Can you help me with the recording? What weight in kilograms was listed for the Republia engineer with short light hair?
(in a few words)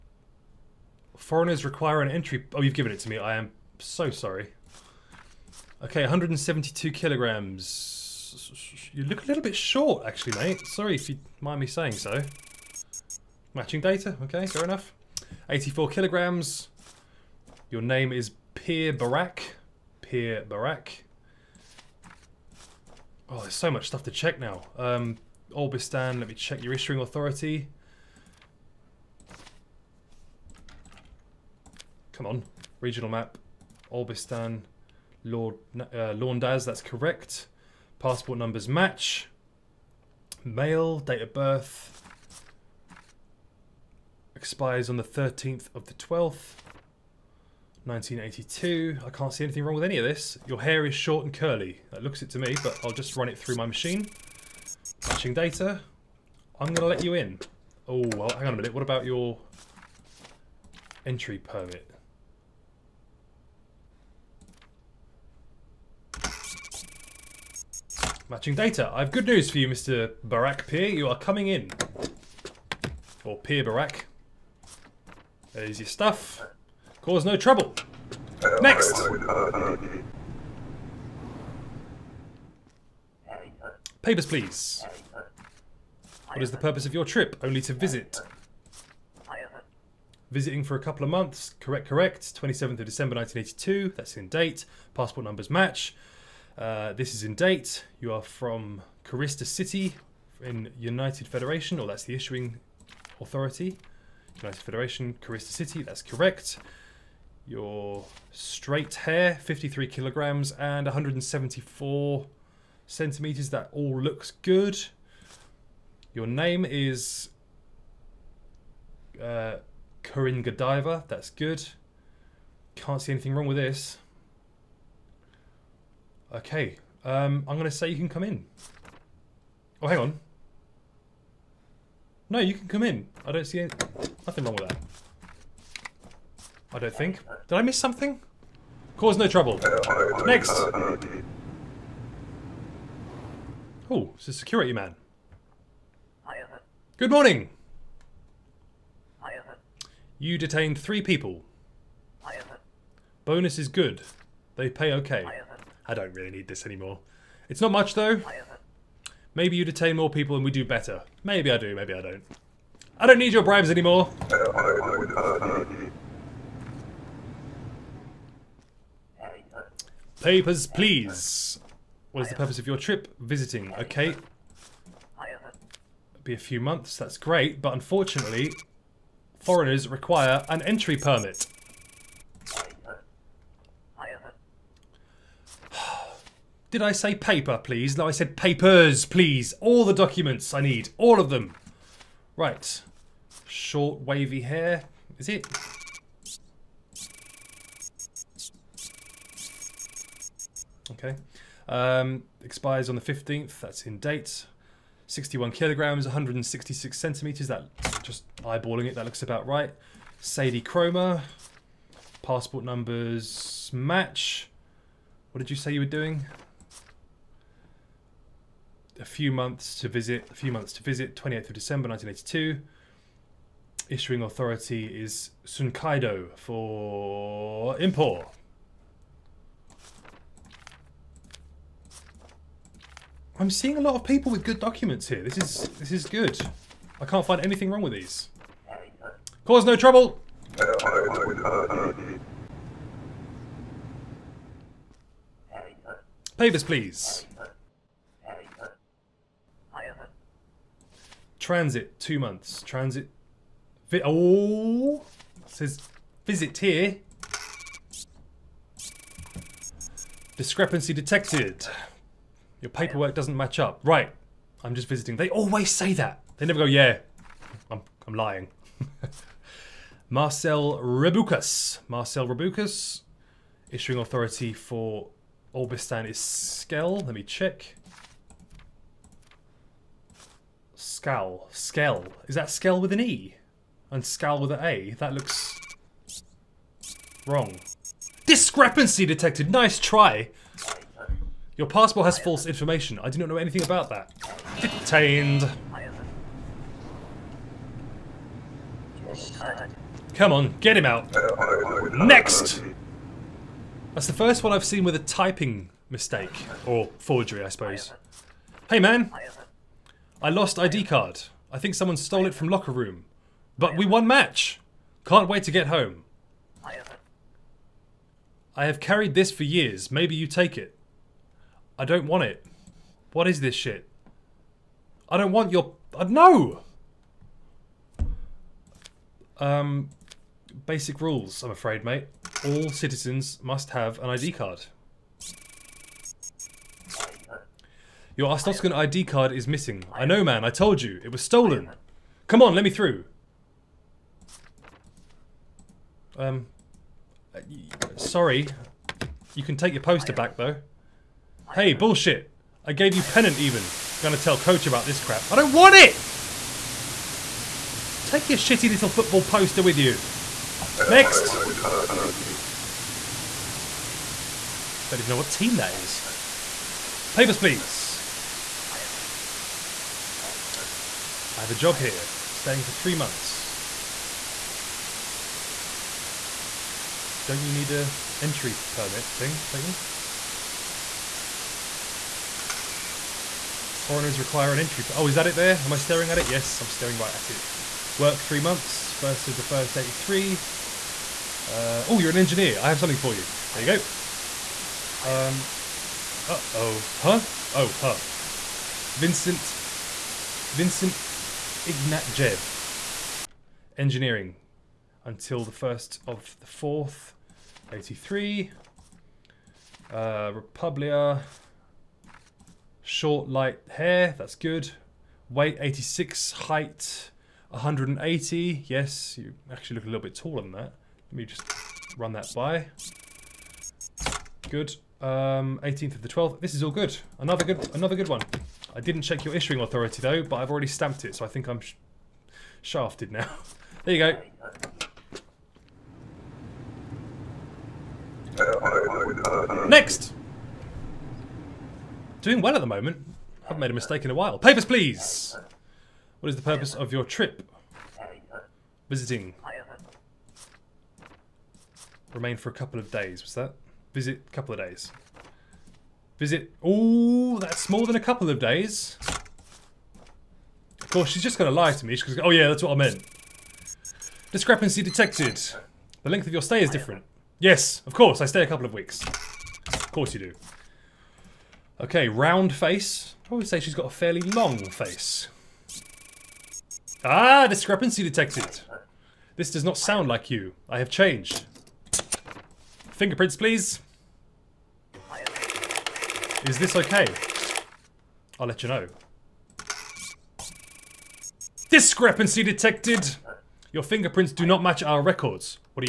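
86.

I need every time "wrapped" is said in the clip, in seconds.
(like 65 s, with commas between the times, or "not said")
not said.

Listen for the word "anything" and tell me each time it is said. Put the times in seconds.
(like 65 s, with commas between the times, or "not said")
49 s, 123 s, 237 s, 293 s.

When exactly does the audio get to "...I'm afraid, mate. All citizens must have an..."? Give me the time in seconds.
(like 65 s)
331 s.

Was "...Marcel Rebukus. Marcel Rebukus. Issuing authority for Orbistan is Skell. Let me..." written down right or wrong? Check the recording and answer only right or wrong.
right.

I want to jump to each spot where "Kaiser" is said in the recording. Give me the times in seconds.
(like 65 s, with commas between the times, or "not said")
not said.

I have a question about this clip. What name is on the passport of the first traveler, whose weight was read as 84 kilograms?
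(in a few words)
Pierre Barak.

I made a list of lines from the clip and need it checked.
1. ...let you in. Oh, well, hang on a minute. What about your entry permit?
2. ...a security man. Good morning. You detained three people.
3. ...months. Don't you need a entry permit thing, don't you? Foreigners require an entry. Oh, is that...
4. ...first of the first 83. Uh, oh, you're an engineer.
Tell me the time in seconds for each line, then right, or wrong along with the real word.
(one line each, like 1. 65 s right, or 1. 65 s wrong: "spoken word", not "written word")
1. 56 s right
2. 144 s right
3. 372 s right
4. 388 s right.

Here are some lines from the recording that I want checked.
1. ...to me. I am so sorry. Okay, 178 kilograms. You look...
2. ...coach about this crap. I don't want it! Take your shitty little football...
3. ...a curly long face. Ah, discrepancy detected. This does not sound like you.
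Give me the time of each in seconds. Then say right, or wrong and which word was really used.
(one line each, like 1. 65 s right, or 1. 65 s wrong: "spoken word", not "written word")
1. 2 s wrong: "172", not "178"
2. 354 s right
3. 473 s wrong: "fairly", not "curly".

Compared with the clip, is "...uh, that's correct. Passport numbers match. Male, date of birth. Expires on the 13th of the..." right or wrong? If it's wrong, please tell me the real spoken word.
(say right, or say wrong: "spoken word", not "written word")
right.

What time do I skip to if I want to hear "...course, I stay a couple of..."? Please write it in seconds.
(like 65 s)
467 s.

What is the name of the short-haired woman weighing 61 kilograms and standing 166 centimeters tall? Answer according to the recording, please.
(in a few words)
Sadie Chroma.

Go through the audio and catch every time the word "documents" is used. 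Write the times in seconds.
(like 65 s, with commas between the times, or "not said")
189 s, 234 s.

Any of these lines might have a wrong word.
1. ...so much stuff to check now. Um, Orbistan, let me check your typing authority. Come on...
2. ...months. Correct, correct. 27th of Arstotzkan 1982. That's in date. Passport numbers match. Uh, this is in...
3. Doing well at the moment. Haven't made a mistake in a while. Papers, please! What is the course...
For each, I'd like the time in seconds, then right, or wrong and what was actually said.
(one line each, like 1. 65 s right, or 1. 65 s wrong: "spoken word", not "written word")
1. 23 s wrong: "issuing", not "typing"
2. 91 s wrong: "December", not "Arstotzkan"
3. 442 s wrong: "purpose", not "course".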